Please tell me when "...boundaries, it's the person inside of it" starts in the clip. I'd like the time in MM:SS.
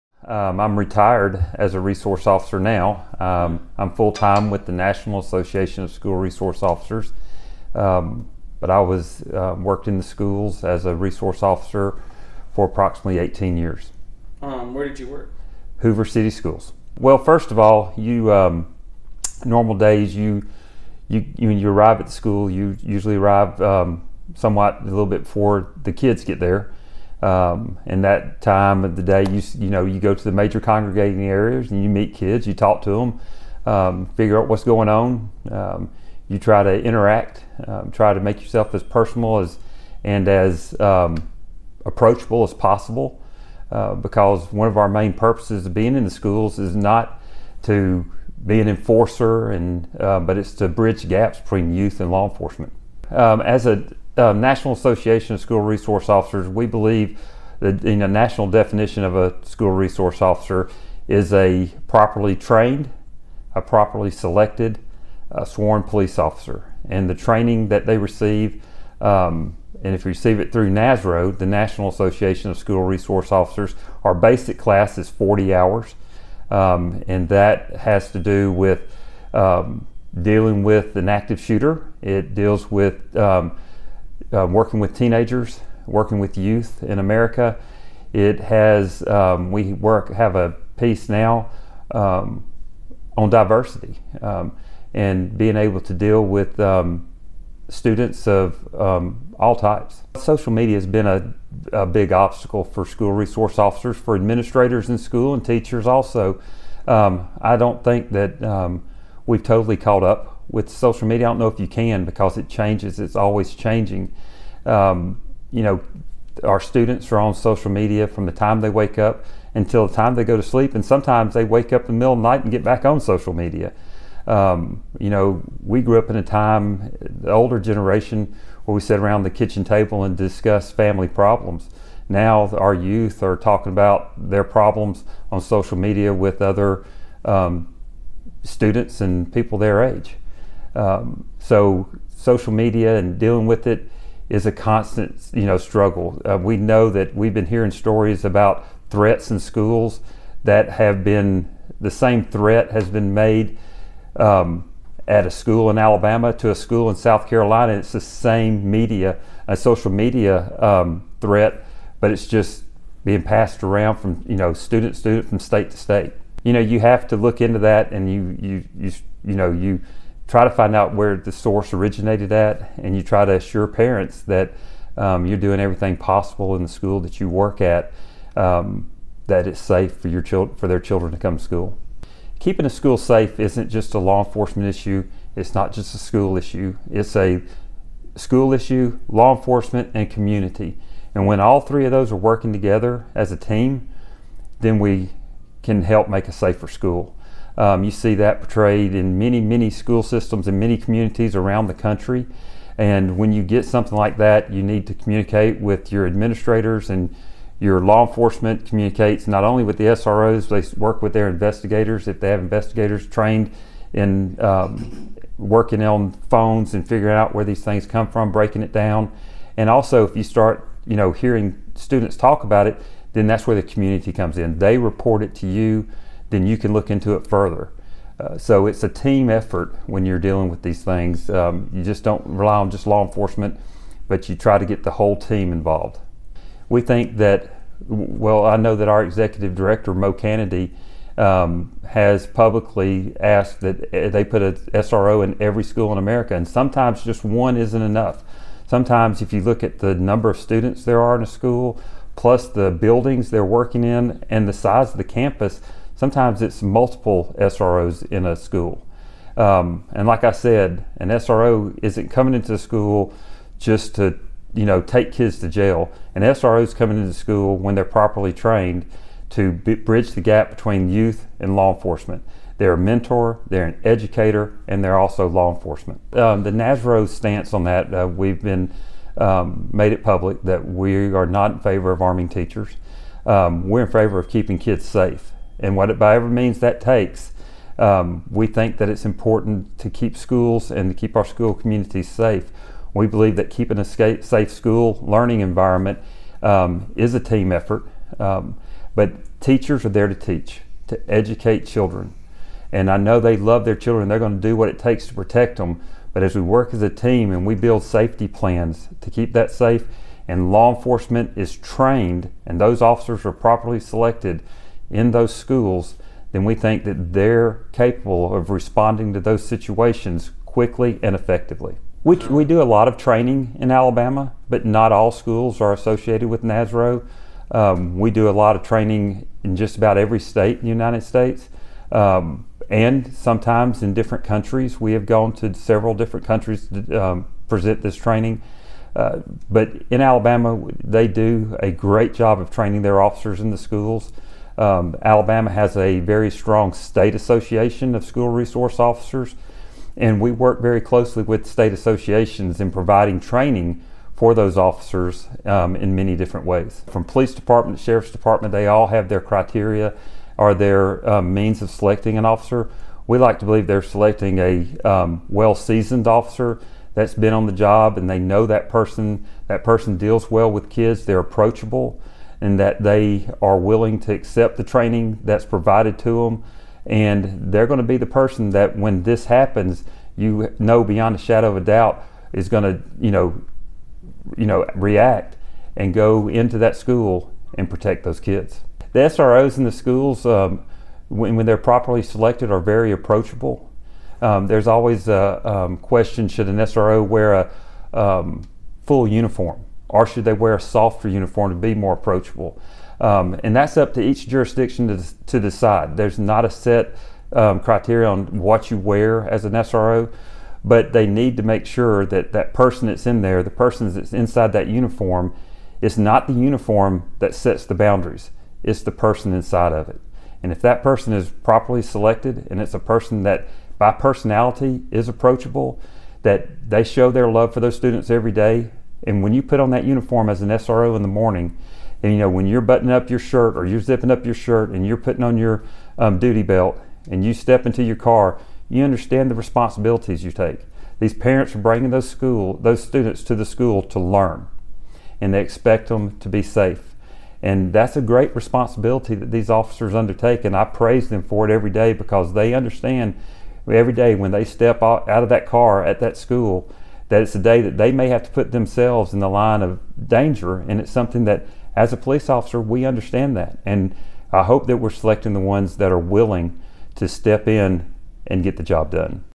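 06:57.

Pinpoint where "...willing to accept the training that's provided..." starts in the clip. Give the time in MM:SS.
06:13.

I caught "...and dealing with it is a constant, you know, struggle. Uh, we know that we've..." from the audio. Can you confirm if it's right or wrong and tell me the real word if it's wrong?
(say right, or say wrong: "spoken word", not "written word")
right.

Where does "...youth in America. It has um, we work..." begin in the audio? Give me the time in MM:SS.
01:26.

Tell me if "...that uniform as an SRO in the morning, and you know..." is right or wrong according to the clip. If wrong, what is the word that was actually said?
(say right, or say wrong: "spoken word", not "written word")
right.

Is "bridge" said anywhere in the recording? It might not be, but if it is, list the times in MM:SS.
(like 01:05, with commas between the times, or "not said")
00:50, 04:29.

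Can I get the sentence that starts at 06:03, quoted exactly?
We like to believe they're selecting a um, well-seasoned officer that's been on the job and they know that person.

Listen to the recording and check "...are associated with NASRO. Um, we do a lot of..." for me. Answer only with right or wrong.
right.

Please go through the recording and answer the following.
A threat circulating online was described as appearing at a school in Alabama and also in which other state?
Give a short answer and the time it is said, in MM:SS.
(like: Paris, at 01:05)
South Carolina, at 02:36.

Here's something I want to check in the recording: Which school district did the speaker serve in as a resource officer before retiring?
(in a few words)
Hoover City Schools.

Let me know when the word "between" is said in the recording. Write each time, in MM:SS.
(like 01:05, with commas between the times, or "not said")
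00:51, 04:30.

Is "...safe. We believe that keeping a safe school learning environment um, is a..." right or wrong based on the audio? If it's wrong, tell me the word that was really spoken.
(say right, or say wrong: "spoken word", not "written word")
right.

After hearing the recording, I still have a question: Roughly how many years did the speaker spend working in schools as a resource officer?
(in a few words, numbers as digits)
18 years.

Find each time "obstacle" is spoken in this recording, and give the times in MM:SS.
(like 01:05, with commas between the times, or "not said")
01:42.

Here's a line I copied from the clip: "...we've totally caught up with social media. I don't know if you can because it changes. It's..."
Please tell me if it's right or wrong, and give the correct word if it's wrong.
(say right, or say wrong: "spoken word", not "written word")
right.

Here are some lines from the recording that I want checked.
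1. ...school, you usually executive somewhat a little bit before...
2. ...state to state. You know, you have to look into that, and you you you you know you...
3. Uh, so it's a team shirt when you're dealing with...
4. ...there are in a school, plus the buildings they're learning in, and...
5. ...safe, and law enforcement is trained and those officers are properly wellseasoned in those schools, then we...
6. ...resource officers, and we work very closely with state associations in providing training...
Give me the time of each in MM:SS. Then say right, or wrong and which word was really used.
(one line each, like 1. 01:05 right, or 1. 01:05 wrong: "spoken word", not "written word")
1. 00:22 wrong: "arrive", not "executive"
2. 02:45 right
3. 03:48 wrong: "effort", not "shirt"
4. 04:10 wrong: "working", not "learning"
5. 05:09 wrong: "selected", not "wellseasoned"
6. 05:48 right.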